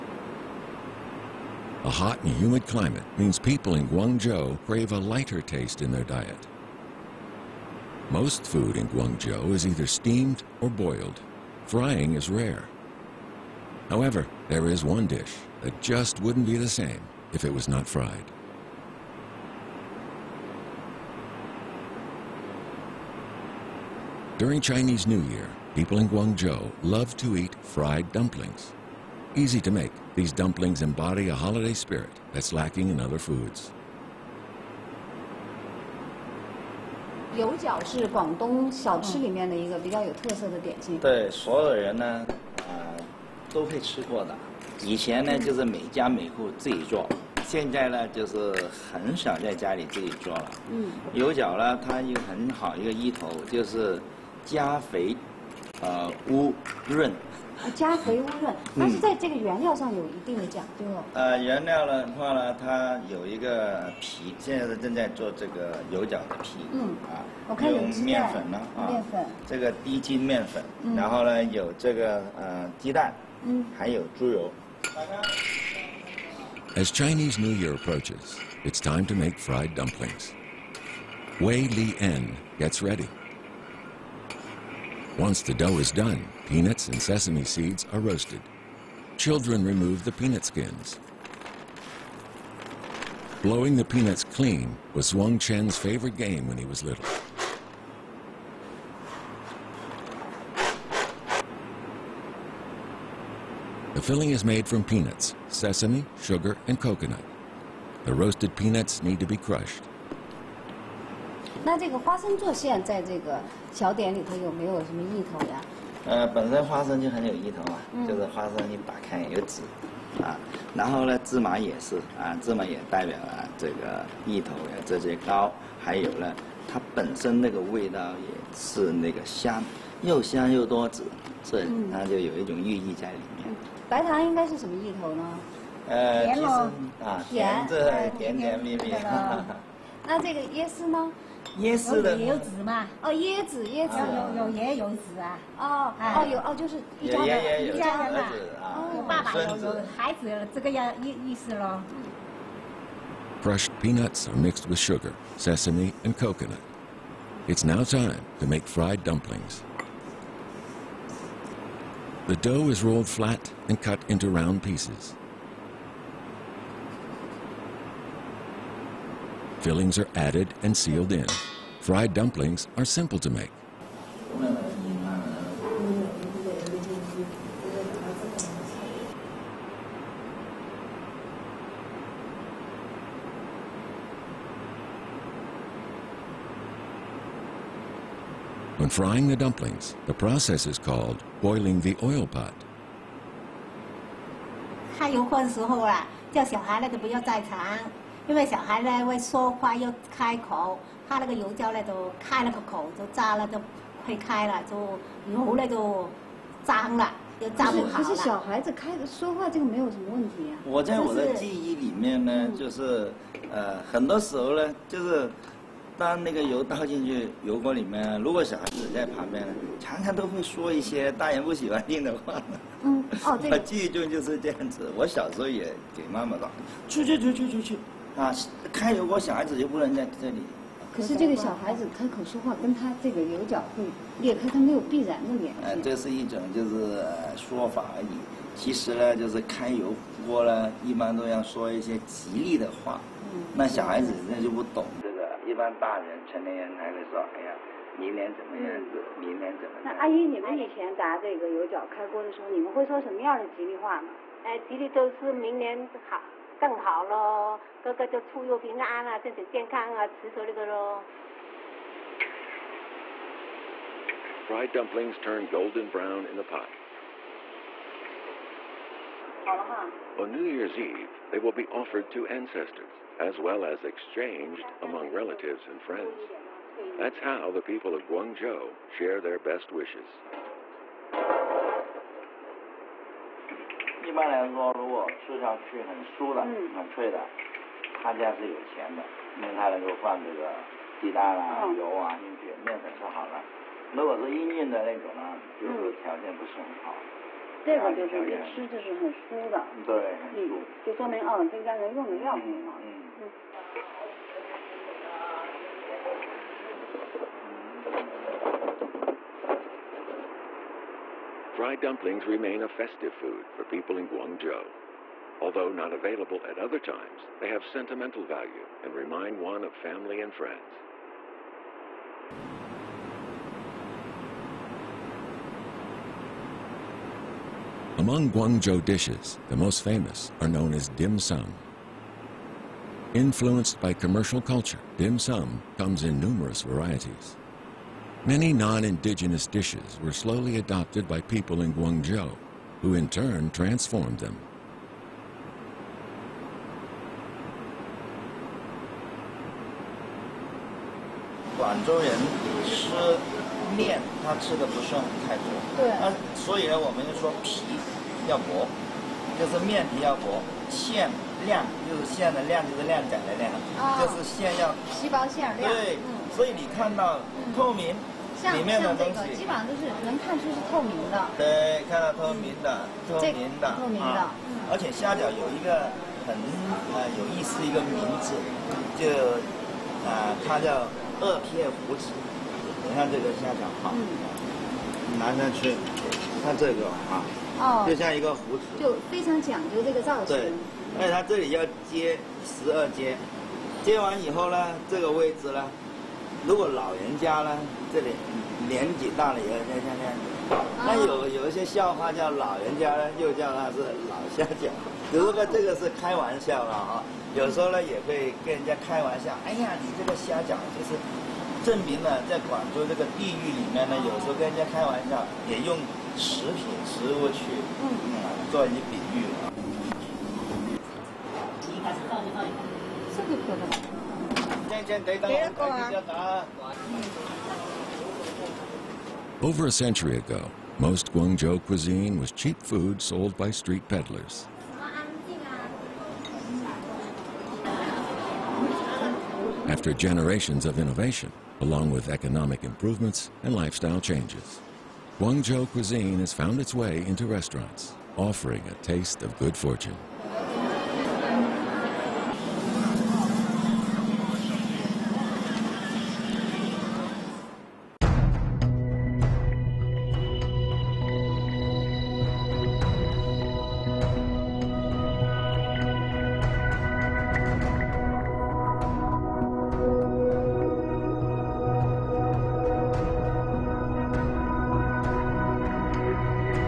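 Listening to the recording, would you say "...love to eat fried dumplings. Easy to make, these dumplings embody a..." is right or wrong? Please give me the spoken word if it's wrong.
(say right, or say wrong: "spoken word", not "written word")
right.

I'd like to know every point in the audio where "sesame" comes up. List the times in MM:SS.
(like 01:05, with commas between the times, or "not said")
01:27, 01:45, 02:35.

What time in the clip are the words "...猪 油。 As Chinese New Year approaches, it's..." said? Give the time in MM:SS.
01:14.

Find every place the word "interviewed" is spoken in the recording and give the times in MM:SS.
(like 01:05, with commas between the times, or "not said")
not said.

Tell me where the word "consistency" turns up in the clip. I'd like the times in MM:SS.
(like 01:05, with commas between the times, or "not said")
not said.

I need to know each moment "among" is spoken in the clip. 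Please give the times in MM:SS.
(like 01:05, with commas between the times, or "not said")
04:34, 05:27.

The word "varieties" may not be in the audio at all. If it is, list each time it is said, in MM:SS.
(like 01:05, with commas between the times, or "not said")
05:36.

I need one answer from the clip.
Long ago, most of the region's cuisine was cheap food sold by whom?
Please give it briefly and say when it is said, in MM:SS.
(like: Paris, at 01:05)
street peddlers, at 07:13.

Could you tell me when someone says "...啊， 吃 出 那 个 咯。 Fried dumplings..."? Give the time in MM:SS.
04:19.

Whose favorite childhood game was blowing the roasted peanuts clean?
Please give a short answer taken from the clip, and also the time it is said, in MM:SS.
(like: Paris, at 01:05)
Wong Chen, at 01:35.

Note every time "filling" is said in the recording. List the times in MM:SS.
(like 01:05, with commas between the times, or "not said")
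01:44, 02:49.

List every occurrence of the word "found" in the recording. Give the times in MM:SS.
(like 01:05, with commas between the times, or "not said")
07:26.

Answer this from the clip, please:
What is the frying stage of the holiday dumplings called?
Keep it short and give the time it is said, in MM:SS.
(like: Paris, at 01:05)
boiling the oil pot, at 03:11.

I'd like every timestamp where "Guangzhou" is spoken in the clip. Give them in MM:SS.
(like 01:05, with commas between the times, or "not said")
00:03, 00:08, 00:26, 04:38, 05:14, 05:28, 07:11, 07:25.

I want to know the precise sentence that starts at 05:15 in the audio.
Although not available at other times, they have sentimental value and remind one of family and friends.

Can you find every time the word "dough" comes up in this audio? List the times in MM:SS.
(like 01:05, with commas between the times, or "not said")
01:25, 02:42.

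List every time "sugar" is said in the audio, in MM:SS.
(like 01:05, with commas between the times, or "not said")
01:46, 02:34.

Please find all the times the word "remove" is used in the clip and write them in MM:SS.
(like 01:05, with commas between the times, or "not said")
01:29.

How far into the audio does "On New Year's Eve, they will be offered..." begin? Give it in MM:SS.
04:30.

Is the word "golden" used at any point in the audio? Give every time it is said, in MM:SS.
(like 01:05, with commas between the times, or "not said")
04:25.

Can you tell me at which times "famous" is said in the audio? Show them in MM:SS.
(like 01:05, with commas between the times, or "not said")
05:29.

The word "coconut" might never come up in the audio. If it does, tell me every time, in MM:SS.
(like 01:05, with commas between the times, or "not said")
01:46, 02:36.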